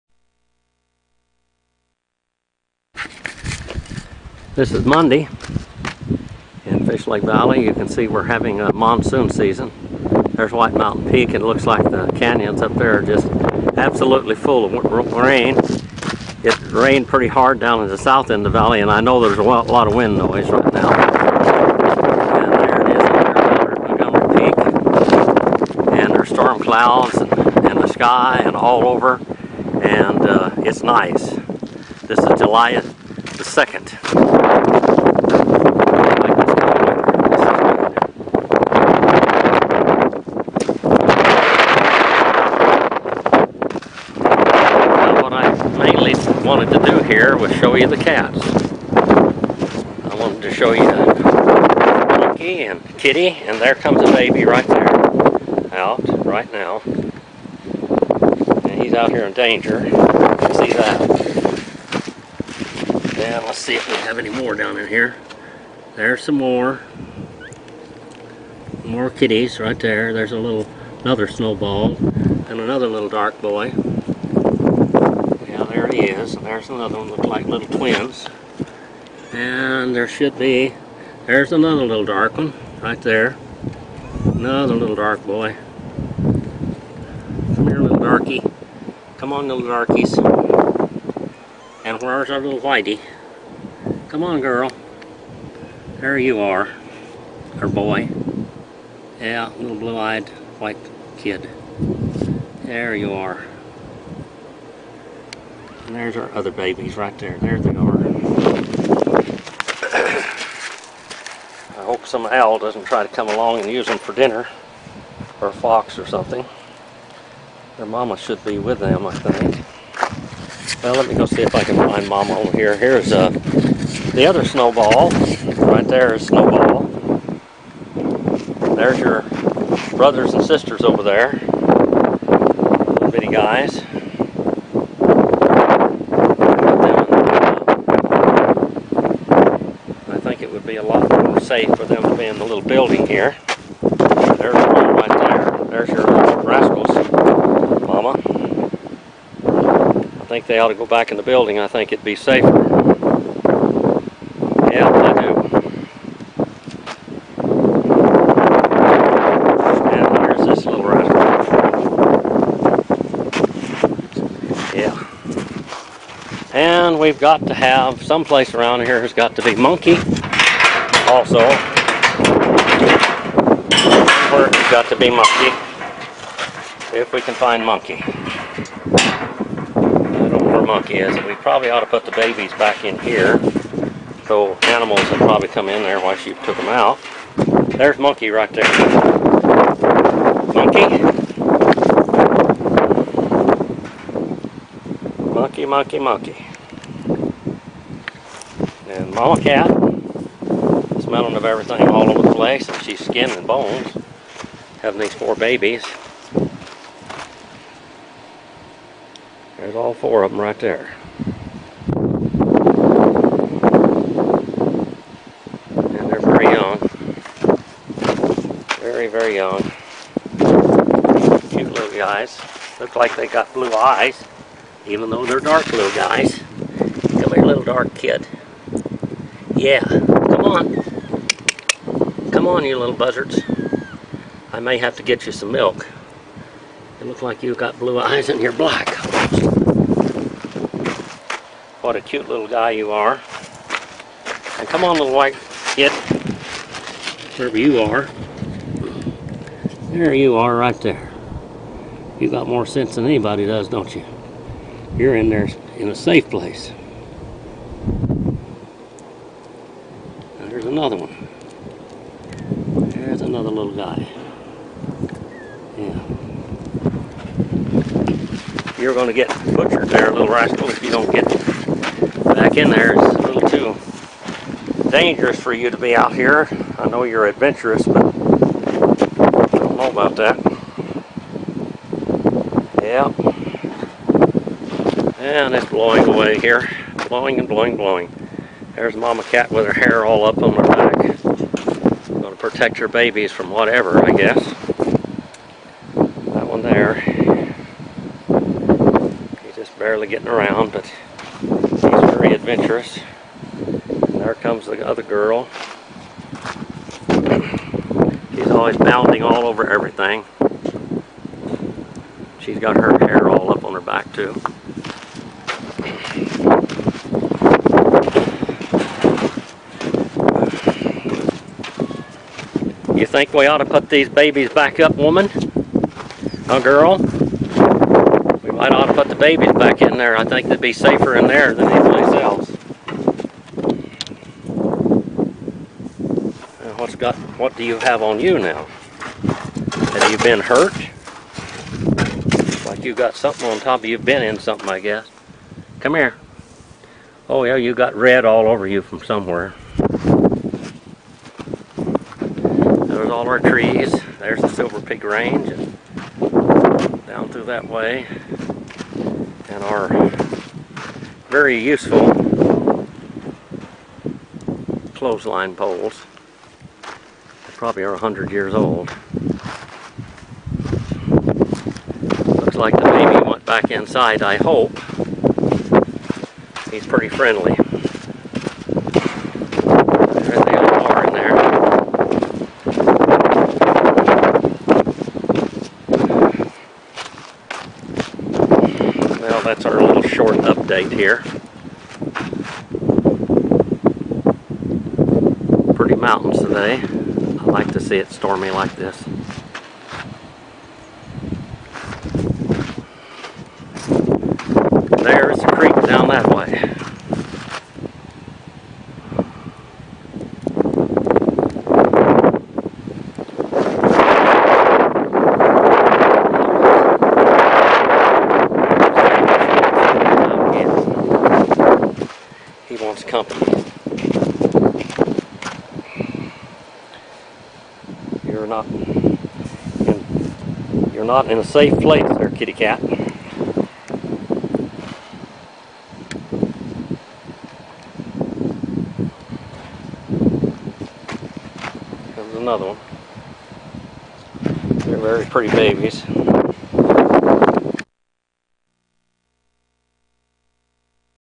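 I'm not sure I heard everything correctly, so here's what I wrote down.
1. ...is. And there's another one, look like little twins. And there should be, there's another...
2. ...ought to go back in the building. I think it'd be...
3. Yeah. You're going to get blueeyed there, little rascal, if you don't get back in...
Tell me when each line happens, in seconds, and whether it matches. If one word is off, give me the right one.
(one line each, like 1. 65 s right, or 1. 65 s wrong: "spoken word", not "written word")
1. 76 s right
2. 150 s right
3. 265 s wrong: "butchered", not "blueeyed".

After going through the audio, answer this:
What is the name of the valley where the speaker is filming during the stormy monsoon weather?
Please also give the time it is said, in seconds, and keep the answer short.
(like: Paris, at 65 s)
Fish Lake Valley, at 6 s.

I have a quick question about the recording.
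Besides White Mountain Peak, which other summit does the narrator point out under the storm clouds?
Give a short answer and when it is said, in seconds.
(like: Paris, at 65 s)
Montgomery Peak, at 23 s.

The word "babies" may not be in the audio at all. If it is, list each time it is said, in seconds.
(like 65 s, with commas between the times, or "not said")
106 s, 182 s, 205 s, 292 s, 324 s, 329 s, 445 s.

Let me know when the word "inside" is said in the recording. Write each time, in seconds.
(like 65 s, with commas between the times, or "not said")
373 s.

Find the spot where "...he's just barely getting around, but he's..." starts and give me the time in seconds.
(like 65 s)
299 s.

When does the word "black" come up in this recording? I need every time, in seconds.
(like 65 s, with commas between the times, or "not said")
238 s.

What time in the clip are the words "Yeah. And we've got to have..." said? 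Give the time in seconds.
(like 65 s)
164 s.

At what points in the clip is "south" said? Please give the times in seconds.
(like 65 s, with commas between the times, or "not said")
17 s.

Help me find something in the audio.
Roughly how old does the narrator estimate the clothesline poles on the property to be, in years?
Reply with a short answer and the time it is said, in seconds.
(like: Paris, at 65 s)
100, at 367 s.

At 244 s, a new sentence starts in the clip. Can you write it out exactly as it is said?
And come on, little white kid.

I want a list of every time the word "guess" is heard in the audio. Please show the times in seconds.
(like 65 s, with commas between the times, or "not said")
294 s, 344 s.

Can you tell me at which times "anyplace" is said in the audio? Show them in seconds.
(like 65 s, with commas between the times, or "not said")
331 s.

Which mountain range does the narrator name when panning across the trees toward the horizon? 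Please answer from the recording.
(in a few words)
Silver Peak Range.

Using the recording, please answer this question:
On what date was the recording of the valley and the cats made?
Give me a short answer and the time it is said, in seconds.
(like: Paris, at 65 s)
July 2nd, at 32 s.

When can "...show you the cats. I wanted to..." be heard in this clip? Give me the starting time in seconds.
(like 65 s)
47 s.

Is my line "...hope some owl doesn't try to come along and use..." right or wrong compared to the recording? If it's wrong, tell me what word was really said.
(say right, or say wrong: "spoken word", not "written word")
right.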